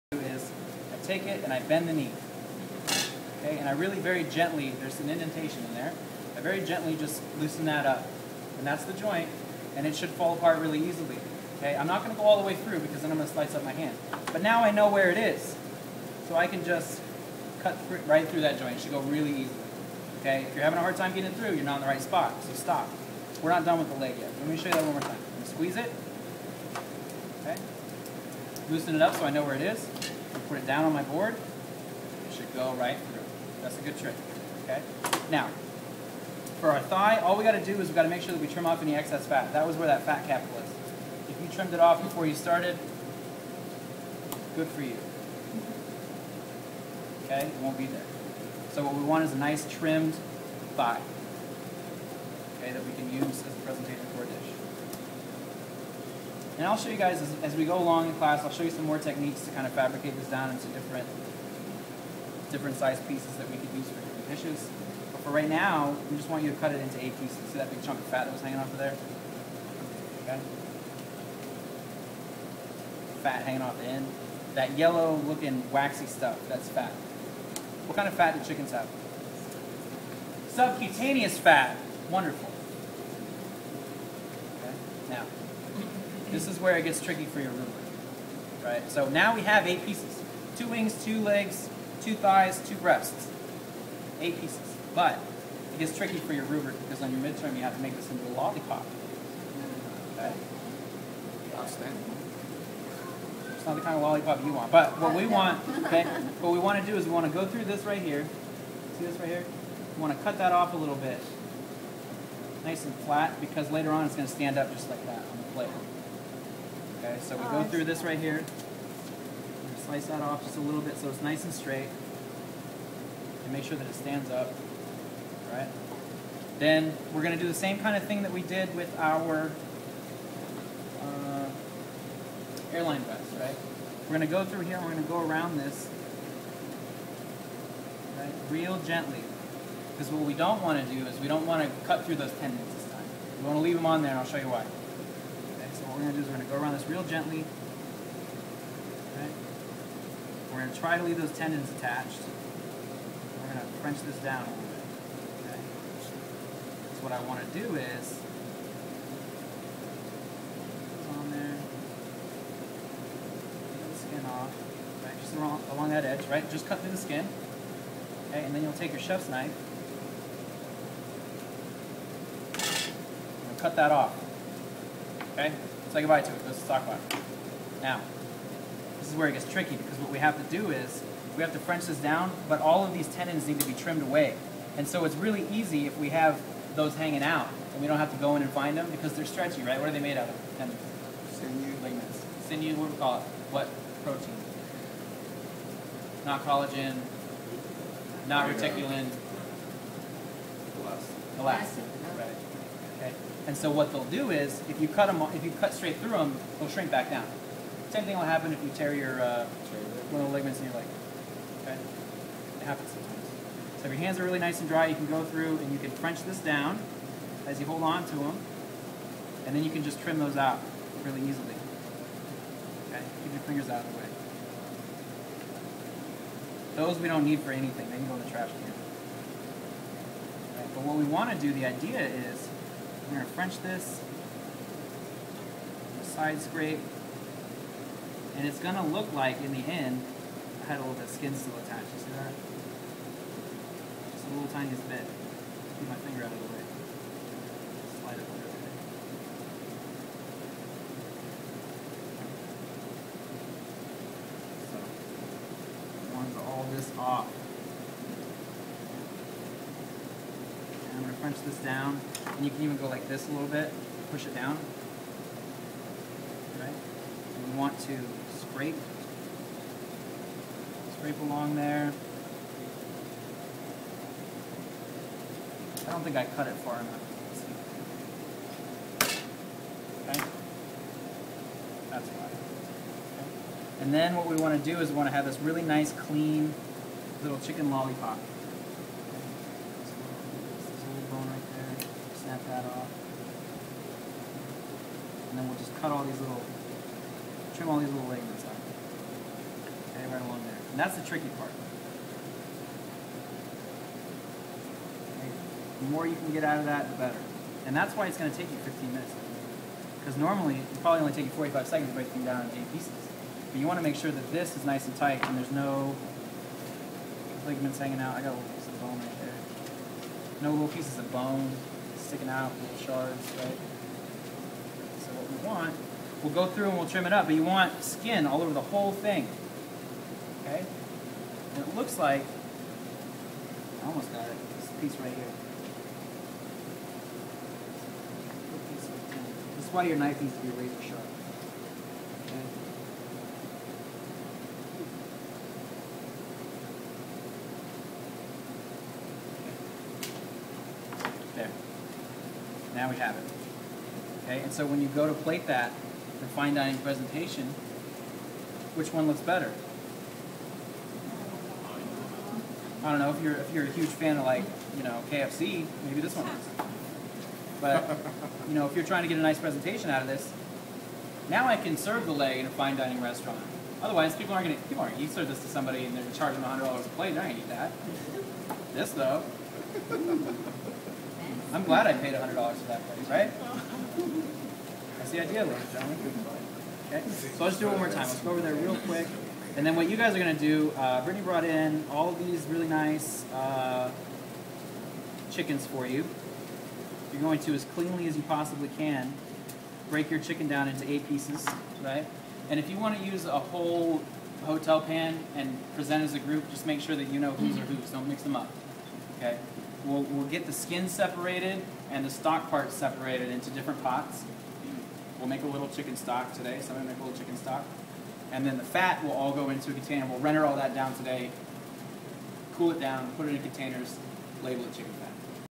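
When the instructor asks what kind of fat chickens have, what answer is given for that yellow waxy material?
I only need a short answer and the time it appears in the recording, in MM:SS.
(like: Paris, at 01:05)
Subcutaneous fat, at 01:20.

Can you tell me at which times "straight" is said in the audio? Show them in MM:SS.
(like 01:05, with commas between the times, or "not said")
02:01, 03:25.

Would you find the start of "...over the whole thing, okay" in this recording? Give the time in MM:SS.
05:28.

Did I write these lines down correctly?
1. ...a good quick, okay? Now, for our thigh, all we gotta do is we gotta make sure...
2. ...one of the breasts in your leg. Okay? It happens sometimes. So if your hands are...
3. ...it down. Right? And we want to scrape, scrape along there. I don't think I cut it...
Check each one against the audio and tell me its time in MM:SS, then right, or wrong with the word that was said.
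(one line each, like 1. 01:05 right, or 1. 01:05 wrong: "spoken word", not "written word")
1. 00:33 wrong: "trick", not "quick"
2. 03:30 wrong: "ligaments", not "breasts"
3. 04:24 right.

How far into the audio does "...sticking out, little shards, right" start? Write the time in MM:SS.
05:22.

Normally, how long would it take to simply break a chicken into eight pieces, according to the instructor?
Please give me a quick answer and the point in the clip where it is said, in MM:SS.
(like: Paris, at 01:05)
45 seconds, at 05:11.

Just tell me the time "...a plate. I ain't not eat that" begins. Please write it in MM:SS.
06:16.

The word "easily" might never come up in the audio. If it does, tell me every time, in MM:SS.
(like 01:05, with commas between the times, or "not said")
00:10, 00:19, 03:41.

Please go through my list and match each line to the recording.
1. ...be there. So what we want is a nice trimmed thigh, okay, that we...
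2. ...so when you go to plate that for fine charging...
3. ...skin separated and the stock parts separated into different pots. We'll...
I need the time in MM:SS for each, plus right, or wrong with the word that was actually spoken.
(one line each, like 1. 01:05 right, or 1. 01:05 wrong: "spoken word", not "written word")
1. 00:47 right
2. 05:54 wrong: "dining", not "charging"
3. 06:50 right.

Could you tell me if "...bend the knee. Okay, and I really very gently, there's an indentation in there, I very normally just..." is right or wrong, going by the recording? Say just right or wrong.
wrong.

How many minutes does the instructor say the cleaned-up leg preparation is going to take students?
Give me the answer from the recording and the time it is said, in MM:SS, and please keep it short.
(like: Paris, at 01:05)
15 minutes, at 05:08.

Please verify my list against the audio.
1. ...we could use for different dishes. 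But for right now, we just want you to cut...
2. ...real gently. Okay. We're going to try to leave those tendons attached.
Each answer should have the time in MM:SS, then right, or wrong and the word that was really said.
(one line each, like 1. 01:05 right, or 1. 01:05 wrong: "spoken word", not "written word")
1. 01:03 right
2. 02:26 right.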